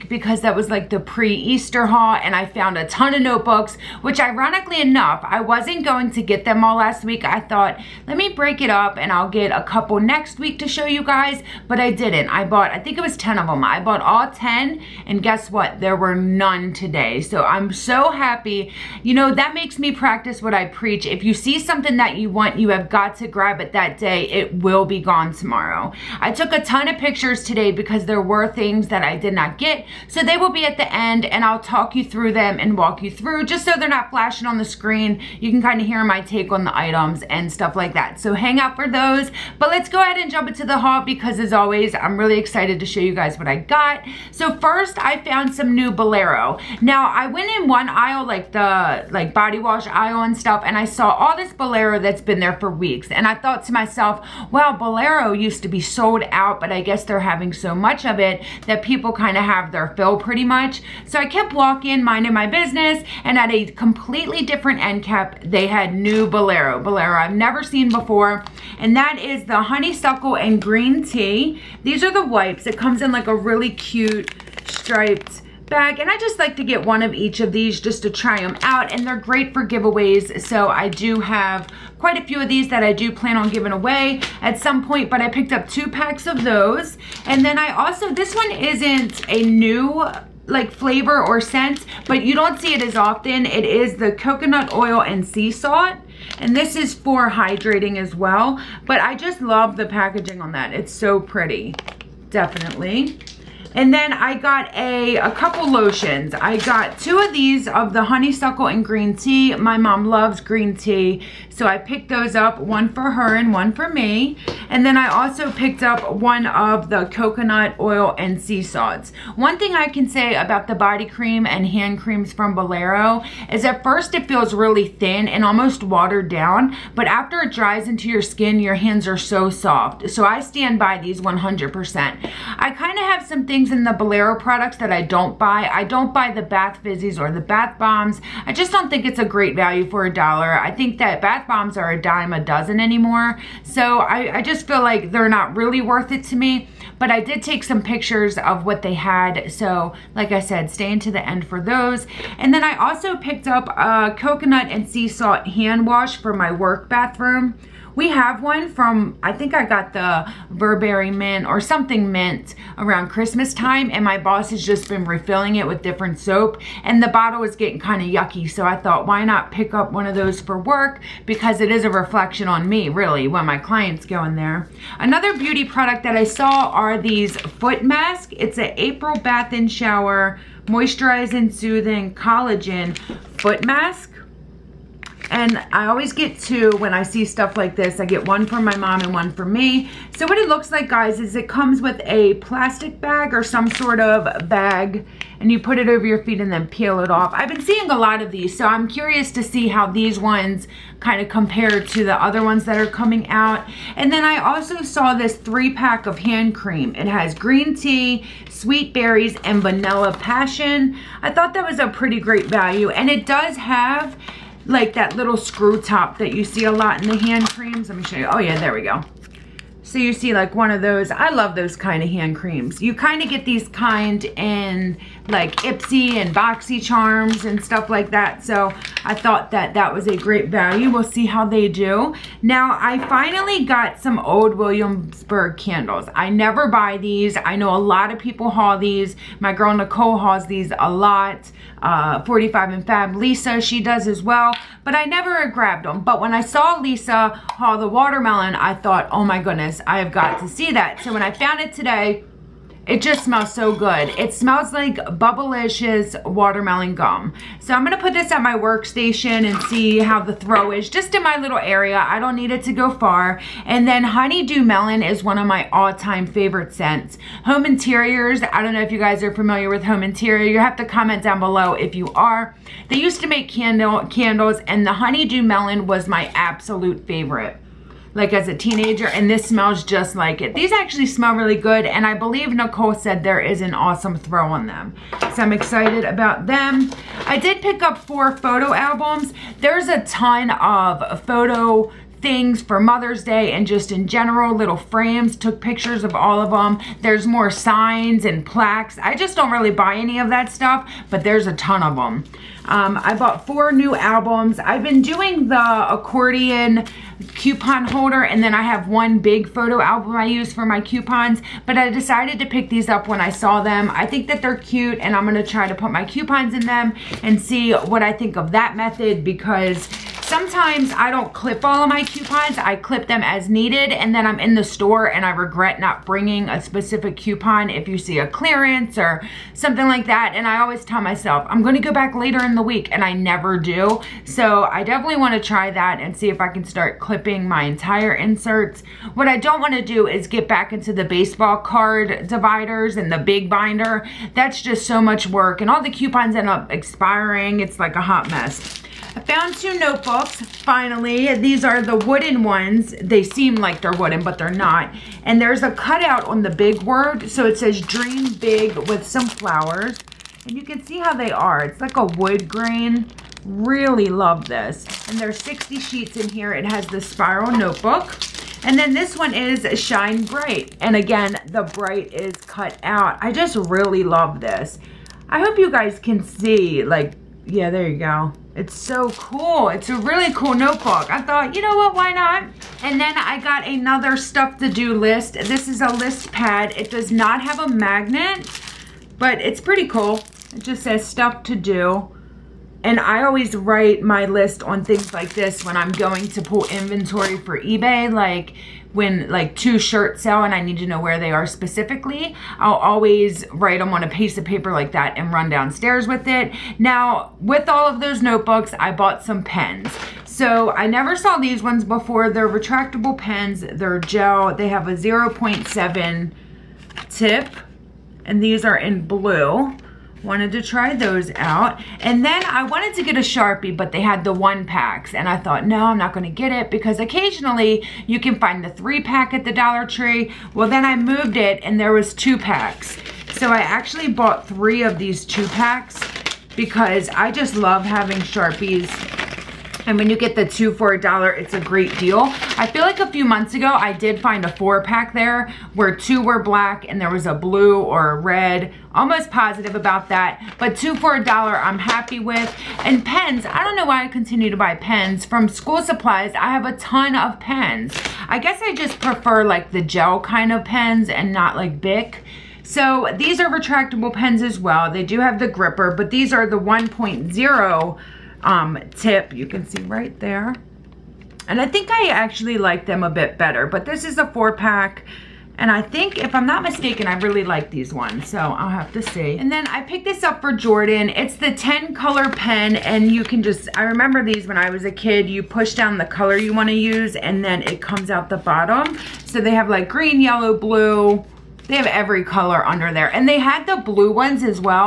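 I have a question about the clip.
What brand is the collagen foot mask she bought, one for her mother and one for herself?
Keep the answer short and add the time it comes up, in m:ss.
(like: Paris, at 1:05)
April Bath and Shower, at 2:58.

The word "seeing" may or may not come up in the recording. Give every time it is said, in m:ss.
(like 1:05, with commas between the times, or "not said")
3:17.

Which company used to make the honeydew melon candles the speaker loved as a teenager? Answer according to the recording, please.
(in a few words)
Home Interiors.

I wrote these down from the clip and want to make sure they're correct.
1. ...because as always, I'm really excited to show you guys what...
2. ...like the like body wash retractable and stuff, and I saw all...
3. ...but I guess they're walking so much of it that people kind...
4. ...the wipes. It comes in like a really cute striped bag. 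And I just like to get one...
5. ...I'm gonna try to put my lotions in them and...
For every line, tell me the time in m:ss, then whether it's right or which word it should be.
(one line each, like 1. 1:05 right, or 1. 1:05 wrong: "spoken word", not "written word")
1. 0:41 right
2. 0:48 wrong: "aisle", not "retractable"
3. 0:56 wrong: "having", not "walking"
4. 1:12 right
5. 5:15 wrong: "coupons", not "lotions".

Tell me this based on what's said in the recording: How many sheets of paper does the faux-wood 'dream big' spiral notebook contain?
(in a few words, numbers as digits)
60.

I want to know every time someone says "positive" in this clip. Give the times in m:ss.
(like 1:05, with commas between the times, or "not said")
7:29.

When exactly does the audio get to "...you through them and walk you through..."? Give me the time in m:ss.
0:31.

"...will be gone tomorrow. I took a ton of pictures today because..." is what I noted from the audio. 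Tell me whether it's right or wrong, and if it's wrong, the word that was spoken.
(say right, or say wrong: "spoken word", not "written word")
right.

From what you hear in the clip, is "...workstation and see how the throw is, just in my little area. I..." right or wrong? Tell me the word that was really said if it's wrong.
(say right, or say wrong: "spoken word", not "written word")
right.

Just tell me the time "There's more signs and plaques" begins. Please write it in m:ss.
4:57.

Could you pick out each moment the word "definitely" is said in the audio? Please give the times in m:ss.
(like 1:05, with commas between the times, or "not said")
1:42, 5:34.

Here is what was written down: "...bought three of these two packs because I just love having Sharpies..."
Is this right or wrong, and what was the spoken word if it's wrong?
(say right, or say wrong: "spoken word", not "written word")
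right.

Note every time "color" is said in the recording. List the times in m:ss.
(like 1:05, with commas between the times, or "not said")
8:01, 8:06, 8:12.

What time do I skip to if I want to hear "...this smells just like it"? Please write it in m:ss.
4:39.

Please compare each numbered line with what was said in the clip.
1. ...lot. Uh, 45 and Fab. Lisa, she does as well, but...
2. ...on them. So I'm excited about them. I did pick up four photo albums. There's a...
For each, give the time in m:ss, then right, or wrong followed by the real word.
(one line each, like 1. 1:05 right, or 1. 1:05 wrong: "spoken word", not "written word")
1. 4:00 right
2. 4:44 right.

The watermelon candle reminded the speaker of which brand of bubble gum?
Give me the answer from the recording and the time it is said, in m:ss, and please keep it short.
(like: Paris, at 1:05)
Bubblicious, at 4:14.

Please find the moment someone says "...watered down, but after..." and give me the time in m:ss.
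2:05.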